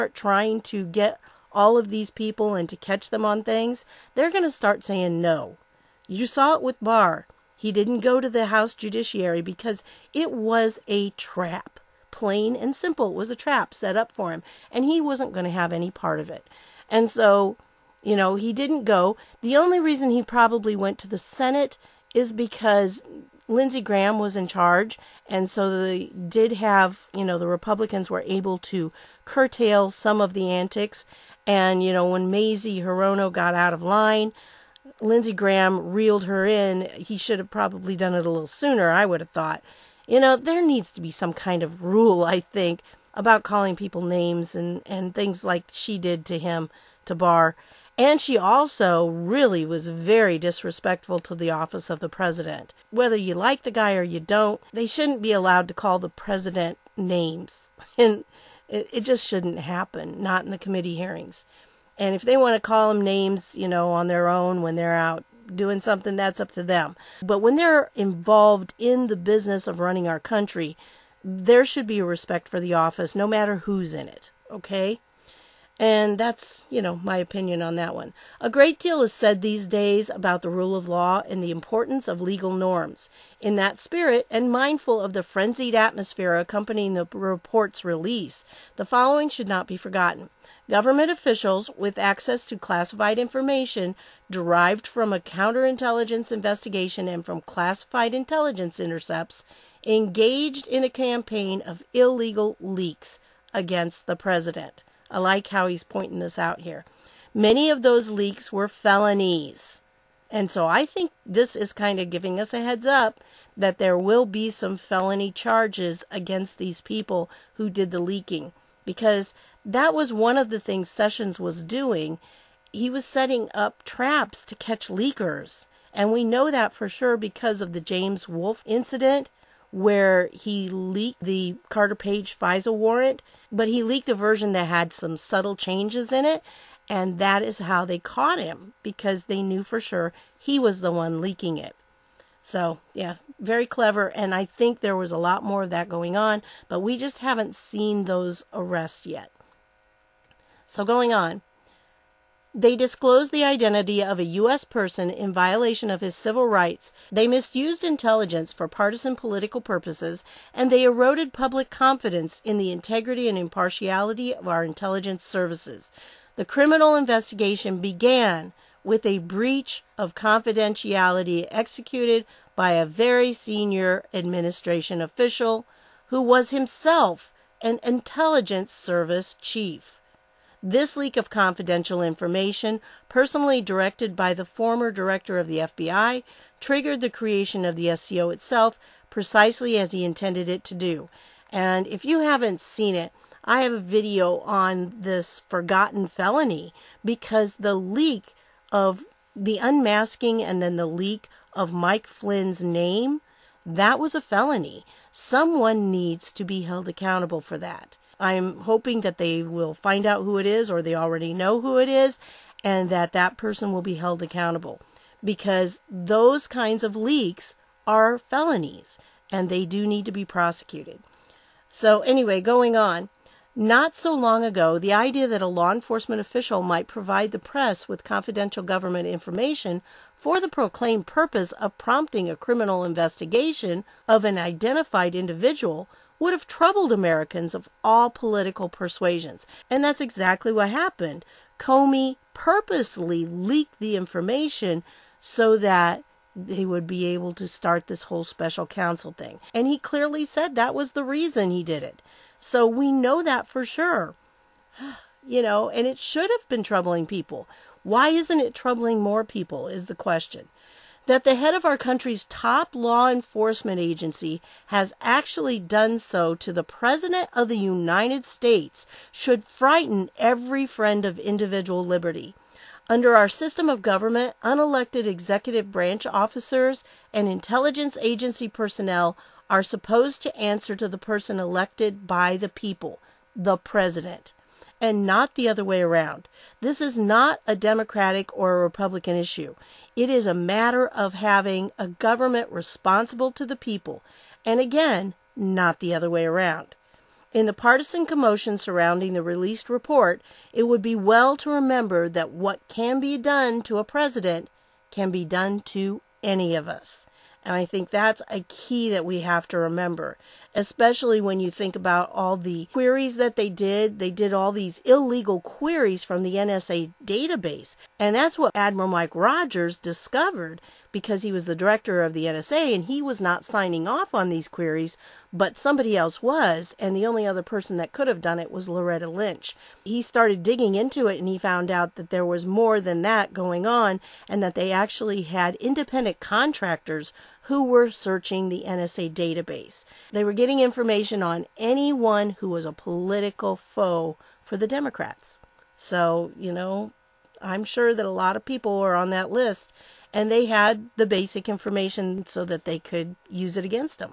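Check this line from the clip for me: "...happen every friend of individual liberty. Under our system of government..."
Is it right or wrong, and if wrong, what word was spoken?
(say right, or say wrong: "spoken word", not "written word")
wrong: "frighten", not "happen".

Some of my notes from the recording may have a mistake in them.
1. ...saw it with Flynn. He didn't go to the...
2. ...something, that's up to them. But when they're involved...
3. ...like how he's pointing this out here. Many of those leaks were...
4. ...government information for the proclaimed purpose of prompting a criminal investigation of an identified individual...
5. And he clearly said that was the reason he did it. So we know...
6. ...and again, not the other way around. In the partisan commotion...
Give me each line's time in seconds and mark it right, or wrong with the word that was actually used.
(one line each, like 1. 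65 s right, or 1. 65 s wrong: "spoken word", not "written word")
1. 6 s wrong: "Barr", not "Flynn"
2. 65 s right
3. 105 s right
4. 228 s right
5. 249 s right
6. 294 s right.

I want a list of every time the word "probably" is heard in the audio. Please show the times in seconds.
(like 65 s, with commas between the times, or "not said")
20 s, 37 s.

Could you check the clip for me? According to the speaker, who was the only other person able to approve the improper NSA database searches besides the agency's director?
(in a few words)
Loretta Lynch.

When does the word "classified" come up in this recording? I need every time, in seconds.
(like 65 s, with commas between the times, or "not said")
92 s, 97 s.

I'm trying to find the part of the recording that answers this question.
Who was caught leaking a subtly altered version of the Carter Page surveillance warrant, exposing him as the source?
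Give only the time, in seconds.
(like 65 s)
127 s.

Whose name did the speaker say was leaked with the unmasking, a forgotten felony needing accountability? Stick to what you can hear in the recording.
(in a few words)
Mike Flynn.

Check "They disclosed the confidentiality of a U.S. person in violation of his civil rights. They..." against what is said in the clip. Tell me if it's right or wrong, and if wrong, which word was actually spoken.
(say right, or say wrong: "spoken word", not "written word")
wrong: "identity", not "confidentiality".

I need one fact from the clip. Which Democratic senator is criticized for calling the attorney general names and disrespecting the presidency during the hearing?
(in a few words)
Mazie Hirono.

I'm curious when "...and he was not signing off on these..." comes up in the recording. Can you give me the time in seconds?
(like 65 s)
322 s.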